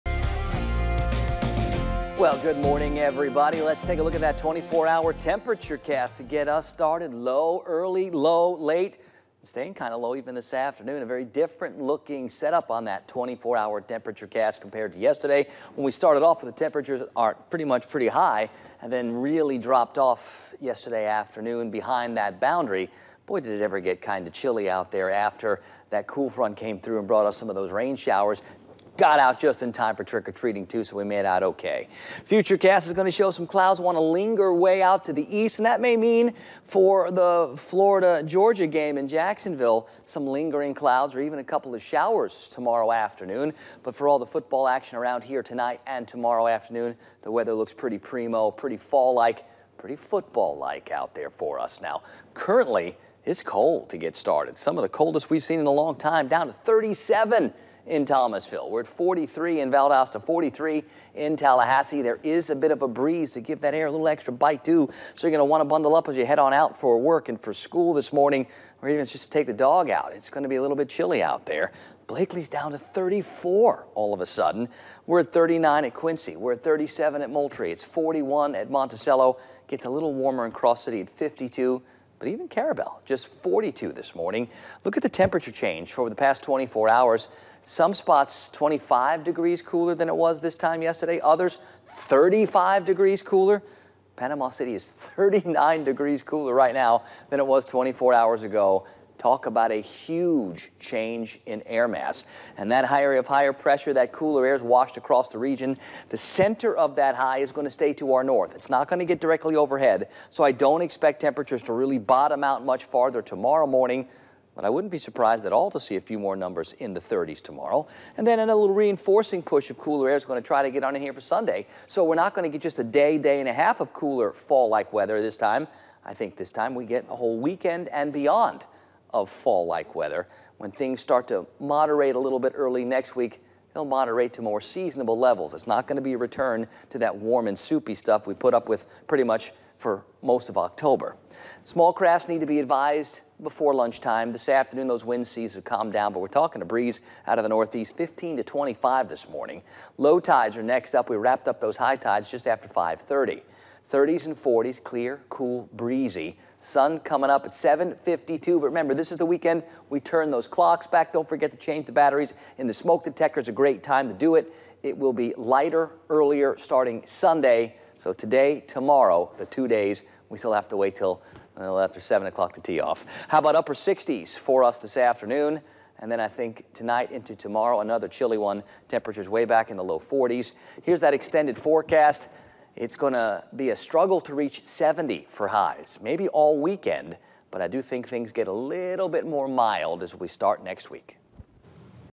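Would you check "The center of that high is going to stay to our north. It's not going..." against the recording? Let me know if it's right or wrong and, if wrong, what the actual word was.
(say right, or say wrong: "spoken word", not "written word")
right.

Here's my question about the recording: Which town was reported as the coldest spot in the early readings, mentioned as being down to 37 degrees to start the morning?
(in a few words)
Thomasville.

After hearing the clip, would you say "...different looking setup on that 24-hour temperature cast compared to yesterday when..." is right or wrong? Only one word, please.
right.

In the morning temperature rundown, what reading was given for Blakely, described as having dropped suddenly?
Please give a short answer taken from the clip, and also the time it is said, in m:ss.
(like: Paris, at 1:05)
34, at 1:12.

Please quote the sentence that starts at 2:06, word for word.
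I think this time we get a whole weekend and beyond of fall-like weather.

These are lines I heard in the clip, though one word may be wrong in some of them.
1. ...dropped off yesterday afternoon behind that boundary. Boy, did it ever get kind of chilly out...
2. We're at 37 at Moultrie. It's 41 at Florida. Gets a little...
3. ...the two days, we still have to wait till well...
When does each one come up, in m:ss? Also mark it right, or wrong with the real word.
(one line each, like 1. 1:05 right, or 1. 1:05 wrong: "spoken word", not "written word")
1. 0:19 right
2. 1:16 wrong: "Monticello", not "Florida"
3. 2:49 right.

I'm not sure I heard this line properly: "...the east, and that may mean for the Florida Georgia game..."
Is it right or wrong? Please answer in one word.
right.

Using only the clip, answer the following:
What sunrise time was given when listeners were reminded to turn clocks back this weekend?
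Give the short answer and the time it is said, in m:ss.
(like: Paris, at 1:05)
7:52, at 2:37.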